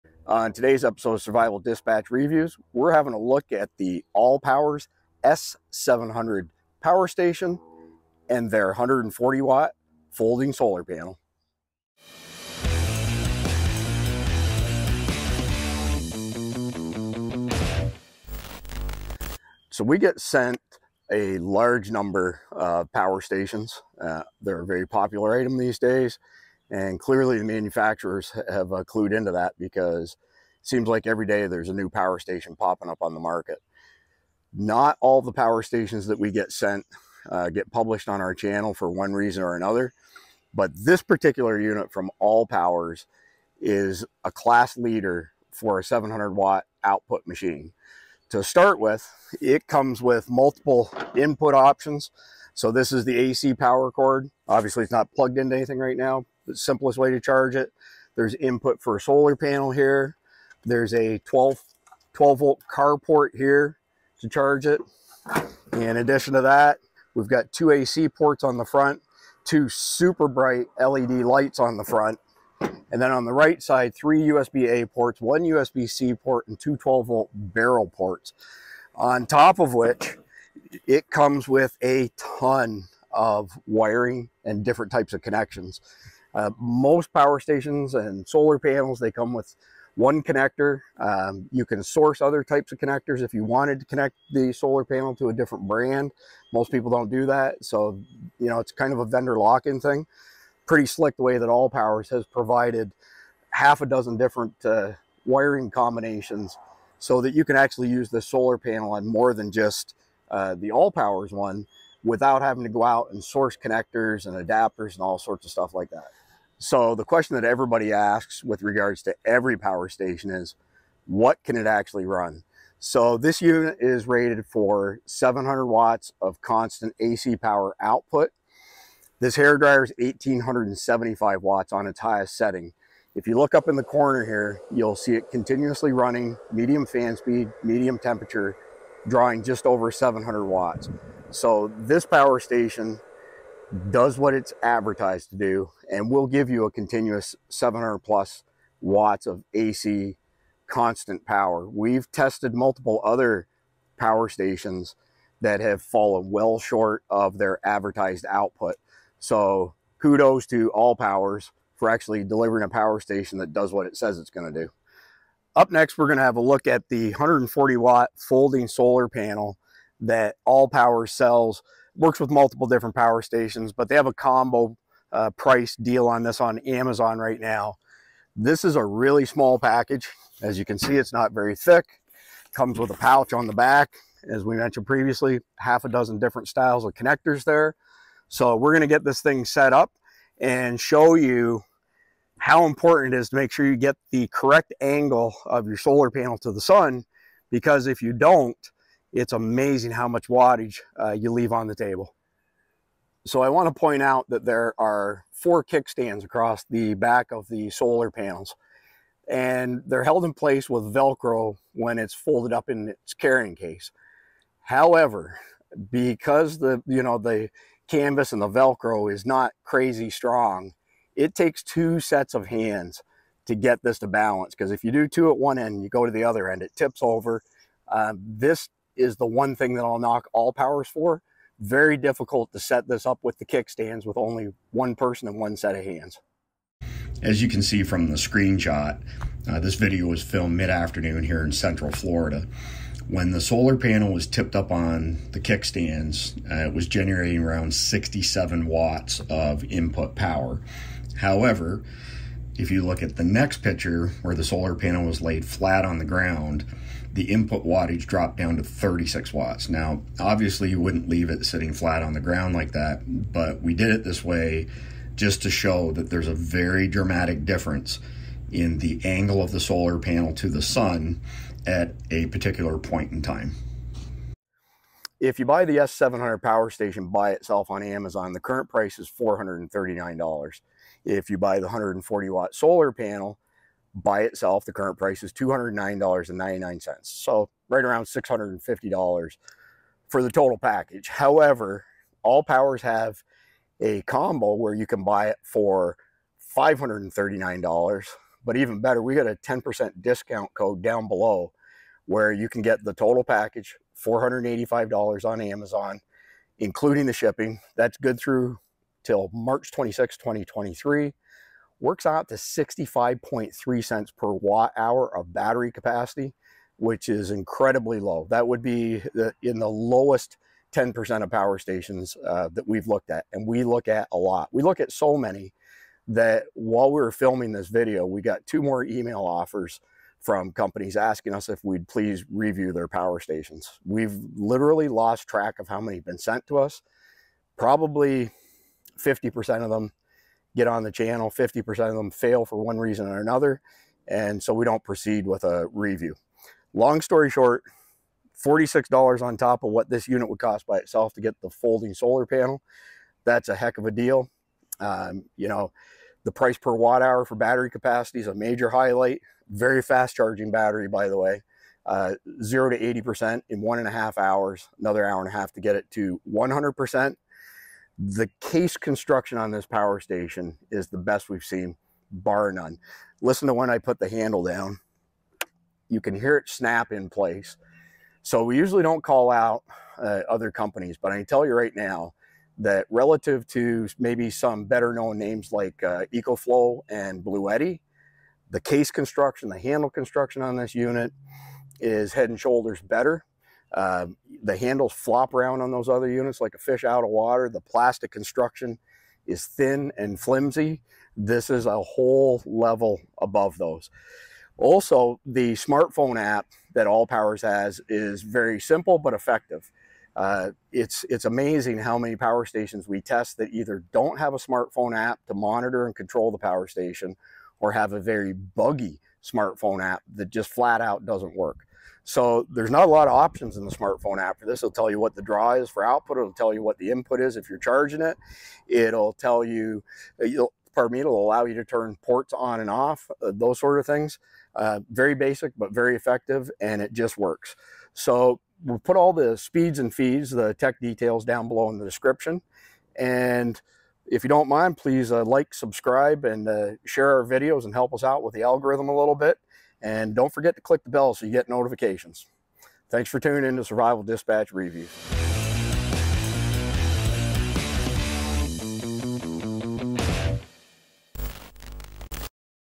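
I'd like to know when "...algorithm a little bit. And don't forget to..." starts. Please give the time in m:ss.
7:28.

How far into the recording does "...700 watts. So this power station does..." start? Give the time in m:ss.
2:19.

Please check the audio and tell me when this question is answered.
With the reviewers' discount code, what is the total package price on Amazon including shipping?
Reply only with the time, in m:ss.
5:04.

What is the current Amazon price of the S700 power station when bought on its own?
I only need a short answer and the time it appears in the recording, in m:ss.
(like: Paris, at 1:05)
$439, at 4:39.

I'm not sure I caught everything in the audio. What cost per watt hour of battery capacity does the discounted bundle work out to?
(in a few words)
65.3 cents.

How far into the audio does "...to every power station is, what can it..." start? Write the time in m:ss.
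1:59.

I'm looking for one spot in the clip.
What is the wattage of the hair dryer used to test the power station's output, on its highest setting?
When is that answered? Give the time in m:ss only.
2:09.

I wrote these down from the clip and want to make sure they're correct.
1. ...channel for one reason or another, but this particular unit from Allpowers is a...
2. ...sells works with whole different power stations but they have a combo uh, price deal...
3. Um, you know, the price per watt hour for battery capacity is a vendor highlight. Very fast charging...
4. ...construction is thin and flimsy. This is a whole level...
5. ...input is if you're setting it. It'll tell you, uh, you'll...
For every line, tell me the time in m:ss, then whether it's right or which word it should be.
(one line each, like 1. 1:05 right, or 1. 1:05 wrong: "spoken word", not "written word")
1. 0:38 right
2. 2:51 wrong: "multiple", not "whole"
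3. 5:54 wrong: "major", not "vendor"
4. 6:38 right
5. 7:06 wrong: "charging", not "setting".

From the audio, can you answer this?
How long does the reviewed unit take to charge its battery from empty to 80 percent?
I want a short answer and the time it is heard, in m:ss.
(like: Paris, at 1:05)
1.5 hours, at 6:03.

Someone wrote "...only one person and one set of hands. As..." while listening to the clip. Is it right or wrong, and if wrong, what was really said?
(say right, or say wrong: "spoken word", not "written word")
right.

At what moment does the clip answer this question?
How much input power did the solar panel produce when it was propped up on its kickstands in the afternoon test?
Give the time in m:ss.
4:07.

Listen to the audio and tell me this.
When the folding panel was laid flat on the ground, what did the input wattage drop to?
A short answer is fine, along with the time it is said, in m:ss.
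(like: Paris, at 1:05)
36 watts, at 4:18.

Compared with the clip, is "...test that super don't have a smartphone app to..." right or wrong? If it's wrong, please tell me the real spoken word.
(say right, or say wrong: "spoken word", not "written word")
wrong: "either", not "super".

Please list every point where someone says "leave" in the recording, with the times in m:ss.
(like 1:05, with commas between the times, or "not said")
3:21, 4:21.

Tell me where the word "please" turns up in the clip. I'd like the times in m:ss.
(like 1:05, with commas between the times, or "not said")
5:31, 7:24.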